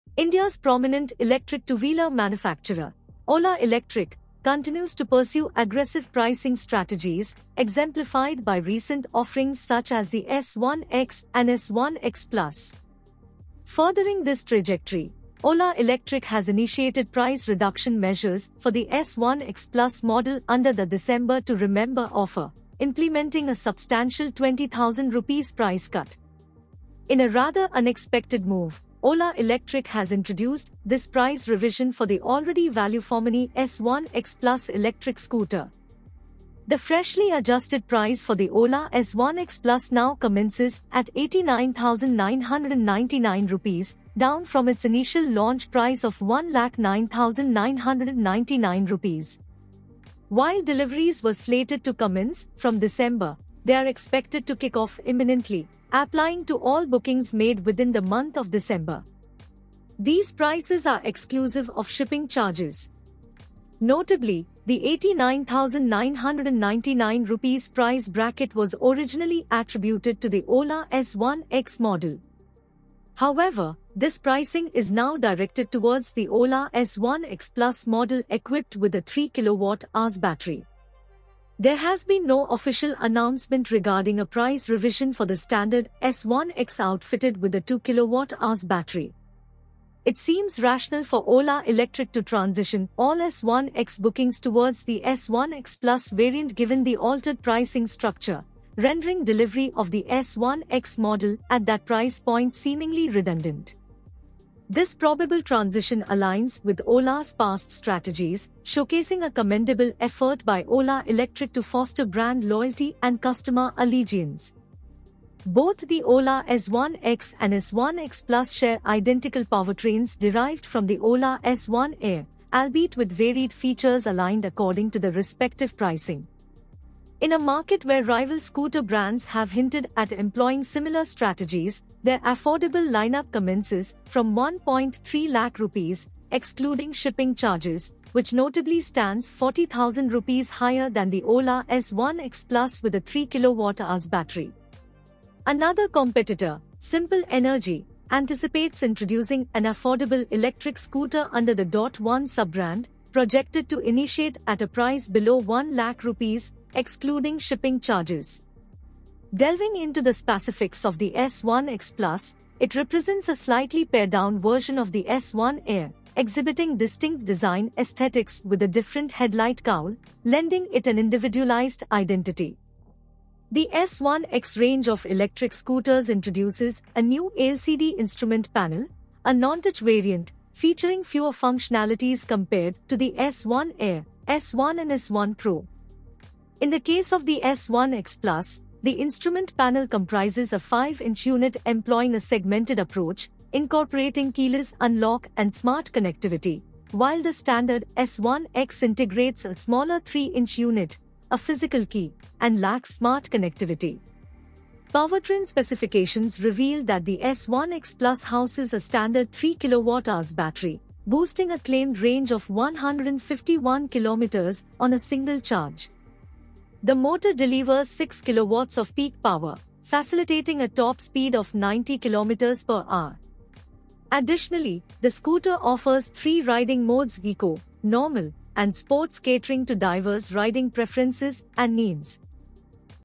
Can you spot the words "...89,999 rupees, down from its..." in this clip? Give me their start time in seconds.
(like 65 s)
41 s.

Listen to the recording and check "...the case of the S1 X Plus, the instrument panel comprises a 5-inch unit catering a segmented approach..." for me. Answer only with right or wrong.
wrong.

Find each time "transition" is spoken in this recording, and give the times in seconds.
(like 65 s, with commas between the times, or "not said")
92 s, 105 s.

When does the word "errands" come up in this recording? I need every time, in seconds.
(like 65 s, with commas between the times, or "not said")
not said.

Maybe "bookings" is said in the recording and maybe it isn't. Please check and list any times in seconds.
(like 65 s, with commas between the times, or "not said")
56 s, 94 s.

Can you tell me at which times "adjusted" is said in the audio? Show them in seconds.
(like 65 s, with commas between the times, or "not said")
37 s.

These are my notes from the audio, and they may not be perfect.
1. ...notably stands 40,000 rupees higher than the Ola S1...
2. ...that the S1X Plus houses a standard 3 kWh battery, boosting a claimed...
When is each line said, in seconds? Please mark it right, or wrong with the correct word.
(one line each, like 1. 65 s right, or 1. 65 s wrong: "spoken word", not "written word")
1. 138 s right
2. 206 s right.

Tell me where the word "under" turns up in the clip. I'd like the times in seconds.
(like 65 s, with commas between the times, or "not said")
20 s, 151 s.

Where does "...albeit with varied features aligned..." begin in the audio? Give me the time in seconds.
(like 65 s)
122 s.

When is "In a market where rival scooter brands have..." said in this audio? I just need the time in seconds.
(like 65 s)
127 s.